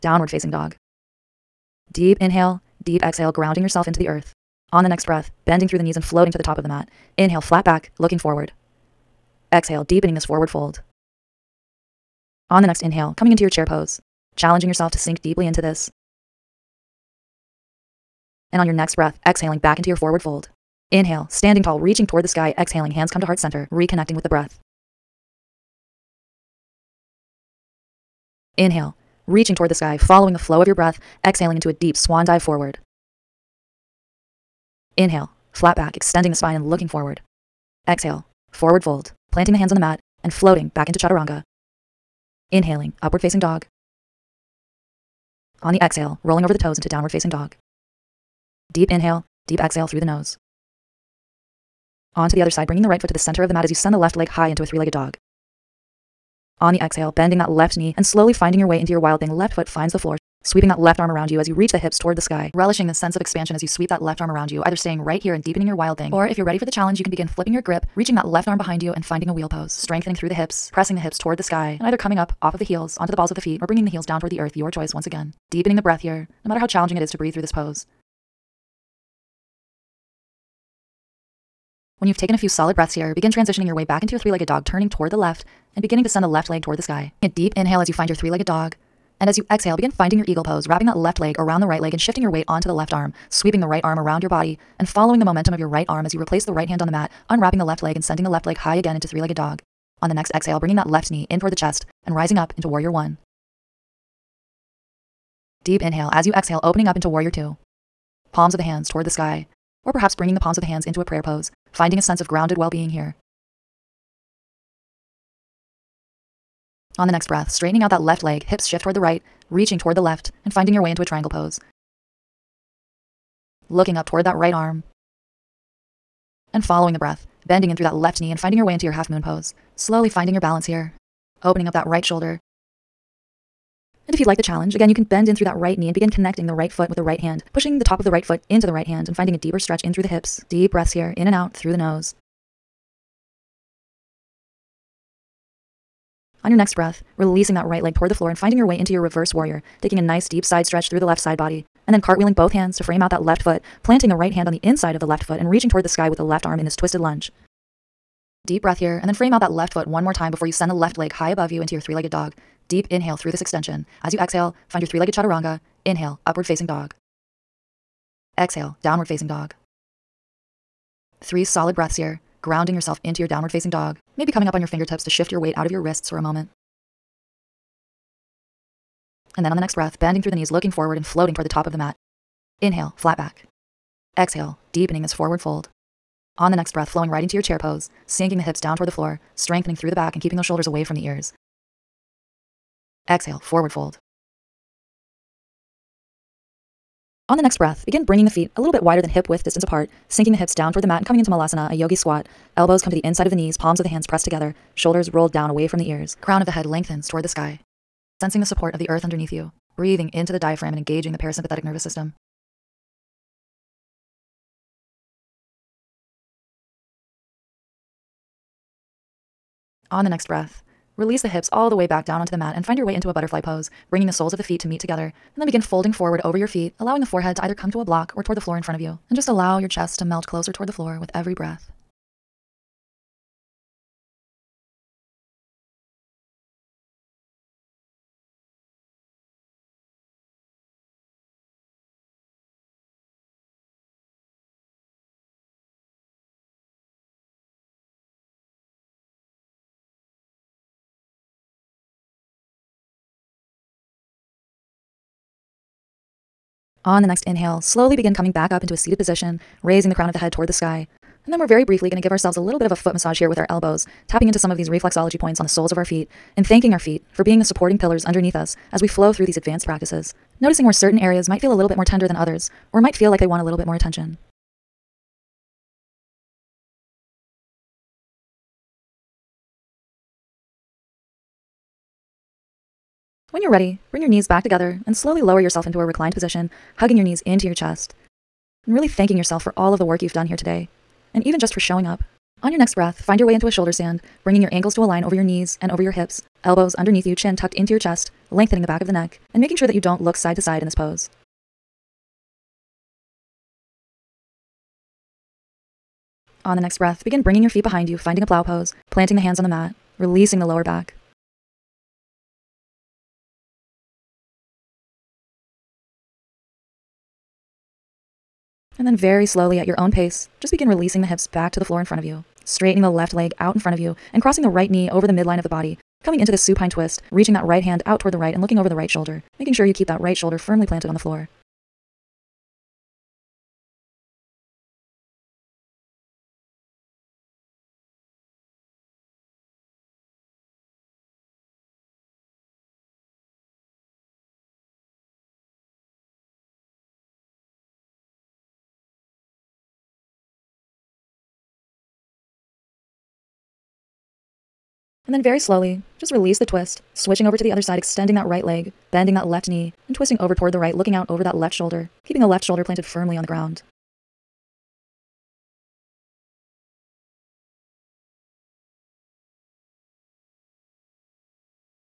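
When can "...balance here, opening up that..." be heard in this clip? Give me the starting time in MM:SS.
02:10.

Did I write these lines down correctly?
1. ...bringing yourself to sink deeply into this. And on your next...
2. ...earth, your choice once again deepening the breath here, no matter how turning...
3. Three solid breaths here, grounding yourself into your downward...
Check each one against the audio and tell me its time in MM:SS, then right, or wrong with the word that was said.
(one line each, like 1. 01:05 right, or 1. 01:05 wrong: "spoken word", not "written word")
1. 00:14 wrong: "challenging", not "bringing"
2. 01:14 wrong: "challenging", not "turning"
3. 02:51 right.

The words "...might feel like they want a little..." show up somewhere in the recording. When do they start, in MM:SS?
04:32.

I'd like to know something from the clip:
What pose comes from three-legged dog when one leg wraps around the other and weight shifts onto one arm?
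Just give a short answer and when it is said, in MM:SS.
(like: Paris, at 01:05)
Eagle pose, at 01:30.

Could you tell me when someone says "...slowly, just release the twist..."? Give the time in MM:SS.
05:55.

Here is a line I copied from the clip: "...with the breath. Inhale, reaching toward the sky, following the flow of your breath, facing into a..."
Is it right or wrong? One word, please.
wrong.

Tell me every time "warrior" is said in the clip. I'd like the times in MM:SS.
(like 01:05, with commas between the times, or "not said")
01:42, 01:47, 02:29.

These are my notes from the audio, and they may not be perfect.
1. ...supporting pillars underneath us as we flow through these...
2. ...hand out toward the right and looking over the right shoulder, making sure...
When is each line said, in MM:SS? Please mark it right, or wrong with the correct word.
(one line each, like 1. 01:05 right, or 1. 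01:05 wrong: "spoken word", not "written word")
1. 04:27 right
2. 05:27 right.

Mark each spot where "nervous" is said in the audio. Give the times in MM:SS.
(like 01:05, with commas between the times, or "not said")
03:31.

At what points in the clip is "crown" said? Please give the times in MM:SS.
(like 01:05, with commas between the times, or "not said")
03:26, 04:19.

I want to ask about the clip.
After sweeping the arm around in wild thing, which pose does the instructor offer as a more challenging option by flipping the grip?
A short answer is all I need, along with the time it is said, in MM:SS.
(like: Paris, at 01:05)
Wheel pose, at 01:09.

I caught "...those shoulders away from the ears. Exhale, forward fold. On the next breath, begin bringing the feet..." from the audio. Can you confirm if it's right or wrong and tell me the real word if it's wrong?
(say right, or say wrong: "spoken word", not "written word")
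right.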